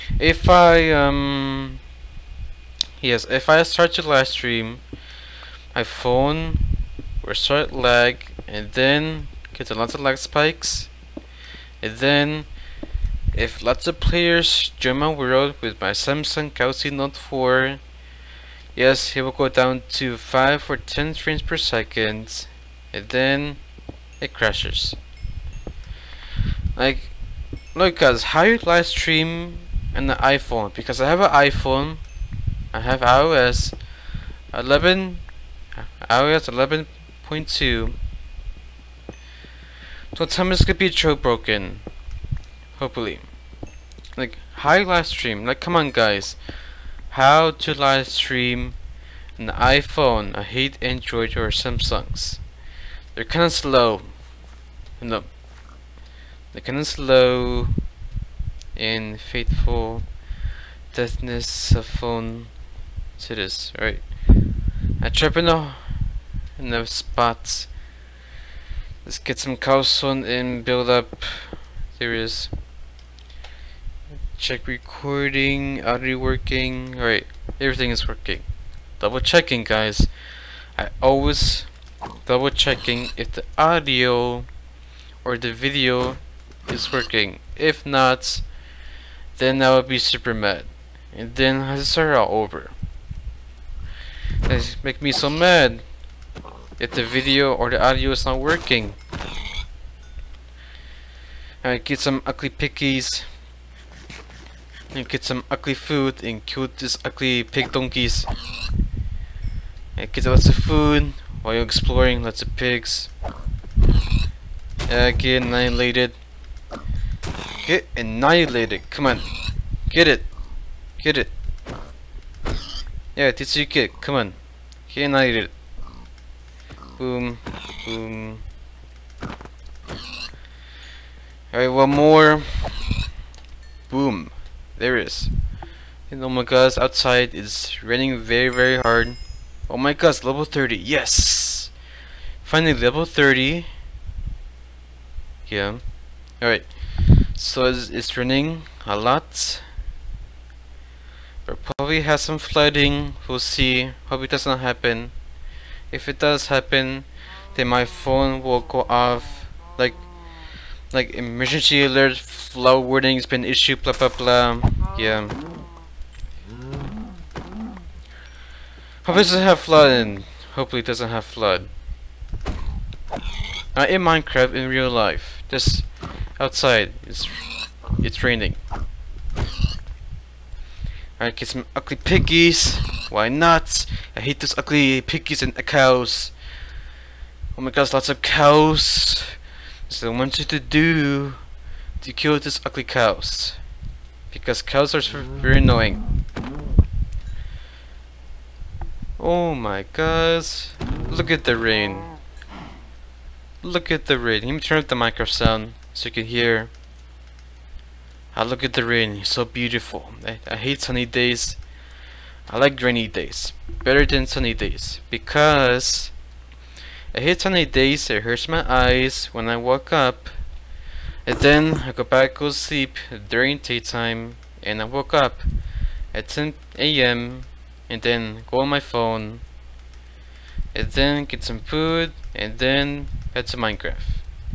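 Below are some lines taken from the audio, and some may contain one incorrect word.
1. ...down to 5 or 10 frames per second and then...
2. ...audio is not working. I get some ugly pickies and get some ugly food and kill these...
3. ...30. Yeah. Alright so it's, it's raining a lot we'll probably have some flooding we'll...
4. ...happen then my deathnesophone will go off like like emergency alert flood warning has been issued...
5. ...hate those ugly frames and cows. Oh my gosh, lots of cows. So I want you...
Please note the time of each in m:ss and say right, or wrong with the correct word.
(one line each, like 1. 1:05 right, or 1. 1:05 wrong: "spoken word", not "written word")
1. 0:19 right
2. 1:37 right
3. 2:23 right
4. 2:36 wrong: "phone", not "deathnesophone"
5. 3:04 wrong: "piggies", not "frames".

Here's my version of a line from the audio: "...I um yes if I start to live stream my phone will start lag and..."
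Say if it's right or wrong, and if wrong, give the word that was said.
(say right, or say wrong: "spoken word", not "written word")
right.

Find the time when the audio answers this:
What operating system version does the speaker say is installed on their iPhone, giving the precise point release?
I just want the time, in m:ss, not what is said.
0:36.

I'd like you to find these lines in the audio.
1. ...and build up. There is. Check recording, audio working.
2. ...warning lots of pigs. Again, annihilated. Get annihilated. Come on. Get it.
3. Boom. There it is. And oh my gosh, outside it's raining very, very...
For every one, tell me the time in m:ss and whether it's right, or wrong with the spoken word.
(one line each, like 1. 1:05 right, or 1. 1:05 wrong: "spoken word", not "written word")
1. 1:10 right
2. 1:51 wrong: "exploring", not "warning"
3. 2:13 right.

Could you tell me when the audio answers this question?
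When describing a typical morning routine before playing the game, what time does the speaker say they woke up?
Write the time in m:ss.
3:46.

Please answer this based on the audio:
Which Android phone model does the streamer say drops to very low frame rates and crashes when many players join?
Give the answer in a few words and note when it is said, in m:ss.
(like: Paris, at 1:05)
Samsung Galaxy Note 4, at 0:15.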